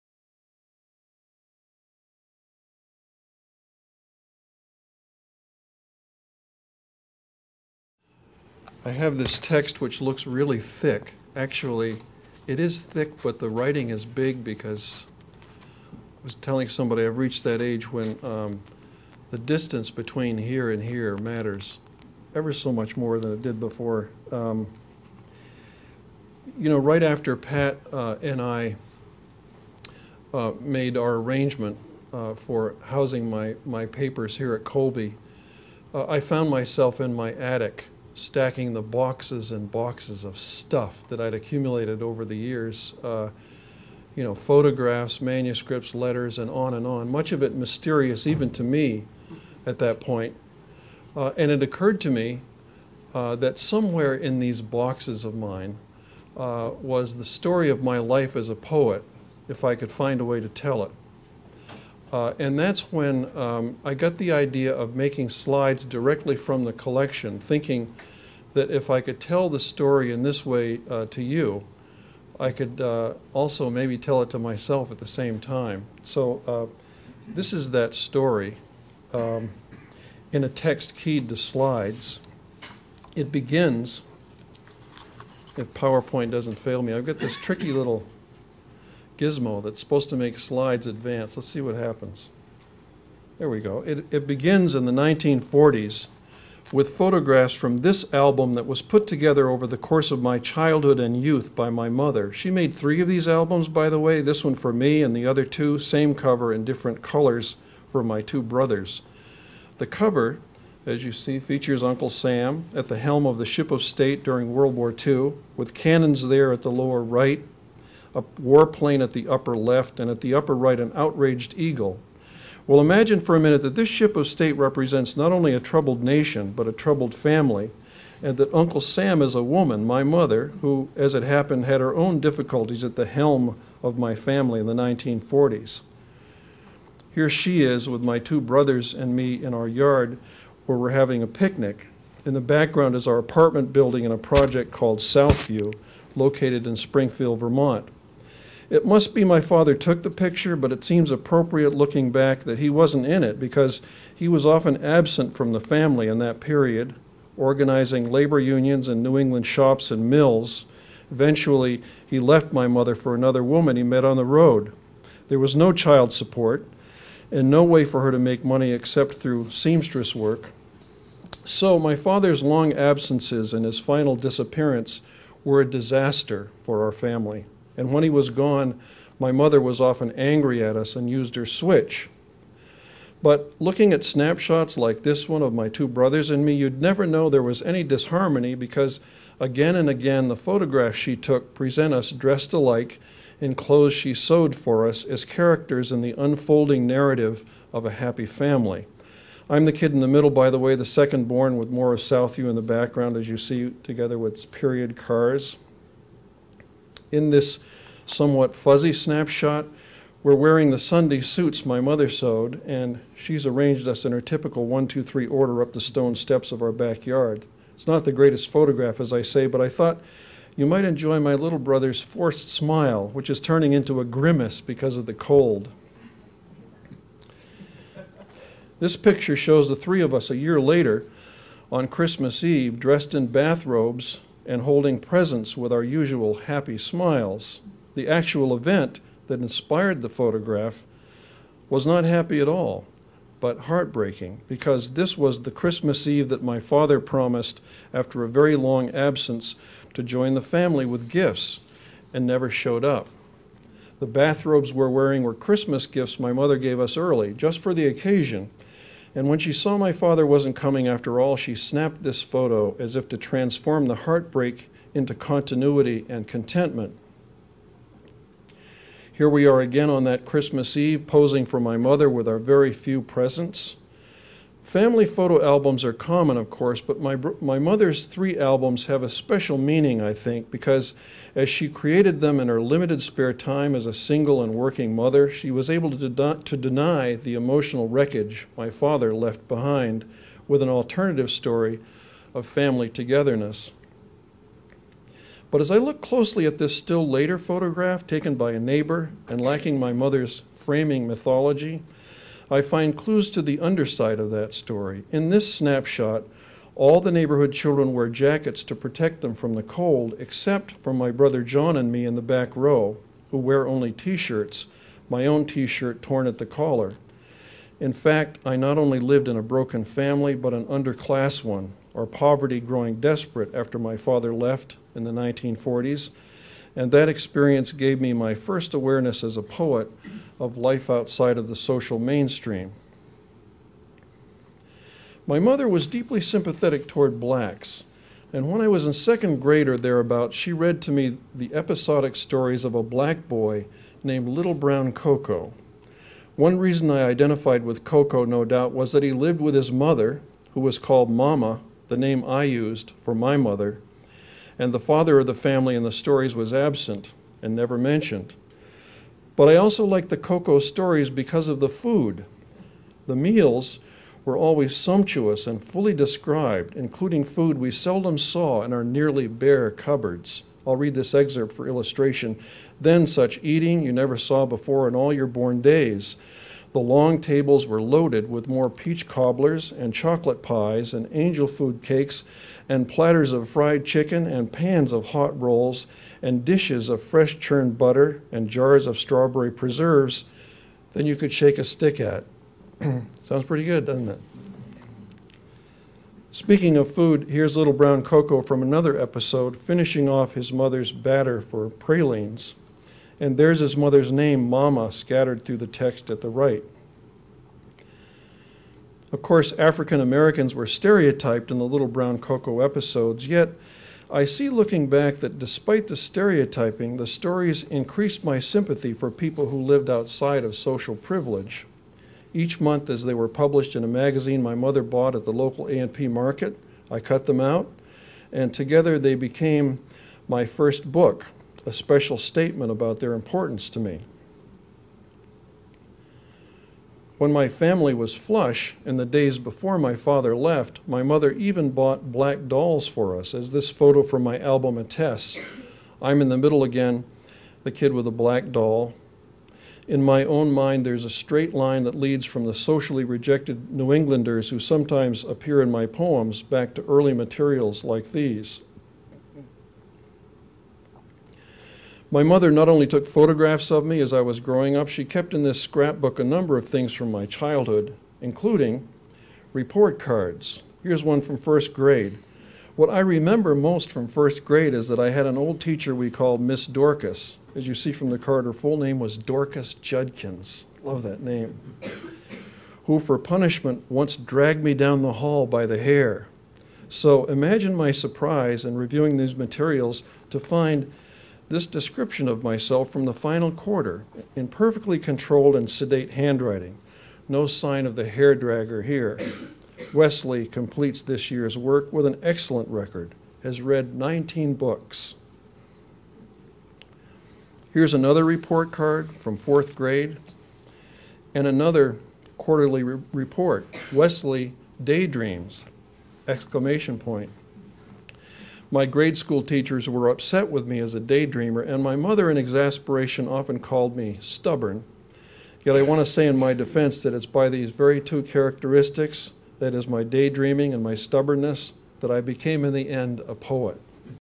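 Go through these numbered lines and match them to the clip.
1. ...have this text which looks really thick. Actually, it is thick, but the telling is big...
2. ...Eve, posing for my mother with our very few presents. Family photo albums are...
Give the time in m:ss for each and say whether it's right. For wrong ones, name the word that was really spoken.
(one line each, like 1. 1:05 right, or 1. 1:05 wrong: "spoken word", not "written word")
1. 0:08 wrong: "writing", not "telling"
2. 4:30 right.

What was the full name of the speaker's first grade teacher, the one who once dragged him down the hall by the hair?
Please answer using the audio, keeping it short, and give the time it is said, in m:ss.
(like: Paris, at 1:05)
Dorcas Judkins, at 7:59.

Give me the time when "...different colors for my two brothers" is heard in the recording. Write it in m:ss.
1:46.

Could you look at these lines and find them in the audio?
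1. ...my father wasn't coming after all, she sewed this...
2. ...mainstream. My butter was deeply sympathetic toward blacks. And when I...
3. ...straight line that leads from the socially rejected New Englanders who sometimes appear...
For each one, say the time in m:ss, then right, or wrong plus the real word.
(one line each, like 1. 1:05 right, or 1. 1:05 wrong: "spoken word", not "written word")
1. 4:19 wrong: "snapped", not "sewed"
2. 5:31 wrong: "mother", not "butter"
3. 7:31 right.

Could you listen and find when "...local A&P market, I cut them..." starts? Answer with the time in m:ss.
7:05.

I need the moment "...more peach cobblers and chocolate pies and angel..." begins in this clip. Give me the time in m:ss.
6:18.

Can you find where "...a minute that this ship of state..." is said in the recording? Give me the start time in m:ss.
2:03.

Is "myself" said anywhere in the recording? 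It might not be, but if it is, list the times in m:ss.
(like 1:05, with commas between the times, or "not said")
0:36, 1:14, 8:12.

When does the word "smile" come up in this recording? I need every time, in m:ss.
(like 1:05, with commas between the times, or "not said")
3:42, 3:56.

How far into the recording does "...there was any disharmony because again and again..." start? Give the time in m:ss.
3:07.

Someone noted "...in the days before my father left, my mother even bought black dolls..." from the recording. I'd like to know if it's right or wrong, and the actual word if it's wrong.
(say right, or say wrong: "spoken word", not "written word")
right.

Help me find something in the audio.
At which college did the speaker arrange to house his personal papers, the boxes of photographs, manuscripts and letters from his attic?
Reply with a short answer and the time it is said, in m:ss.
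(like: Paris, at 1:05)
Colby, at 0:34.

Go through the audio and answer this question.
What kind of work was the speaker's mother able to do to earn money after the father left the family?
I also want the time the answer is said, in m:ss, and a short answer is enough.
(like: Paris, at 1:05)
Seamstress work, at 2:49.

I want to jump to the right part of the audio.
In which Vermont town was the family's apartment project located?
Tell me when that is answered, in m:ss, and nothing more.
2:26.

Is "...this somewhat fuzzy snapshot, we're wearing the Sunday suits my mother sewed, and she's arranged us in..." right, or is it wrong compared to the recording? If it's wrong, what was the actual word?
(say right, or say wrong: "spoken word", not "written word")
right.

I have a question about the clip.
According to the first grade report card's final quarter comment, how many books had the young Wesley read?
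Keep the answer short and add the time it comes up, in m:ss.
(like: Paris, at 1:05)
19, at 8:23.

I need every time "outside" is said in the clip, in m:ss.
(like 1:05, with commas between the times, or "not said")
5:30, 6:59.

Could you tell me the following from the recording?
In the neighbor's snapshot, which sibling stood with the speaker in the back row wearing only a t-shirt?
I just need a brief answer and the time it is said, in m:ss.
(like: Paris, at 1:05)
John, at 5:11.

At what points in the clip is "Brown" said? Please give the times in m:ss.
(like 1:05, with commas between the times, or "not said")
5:44, 6:37, 6:51.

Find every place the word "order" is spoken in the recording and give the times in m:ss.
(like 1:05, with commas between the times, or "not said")
3:35.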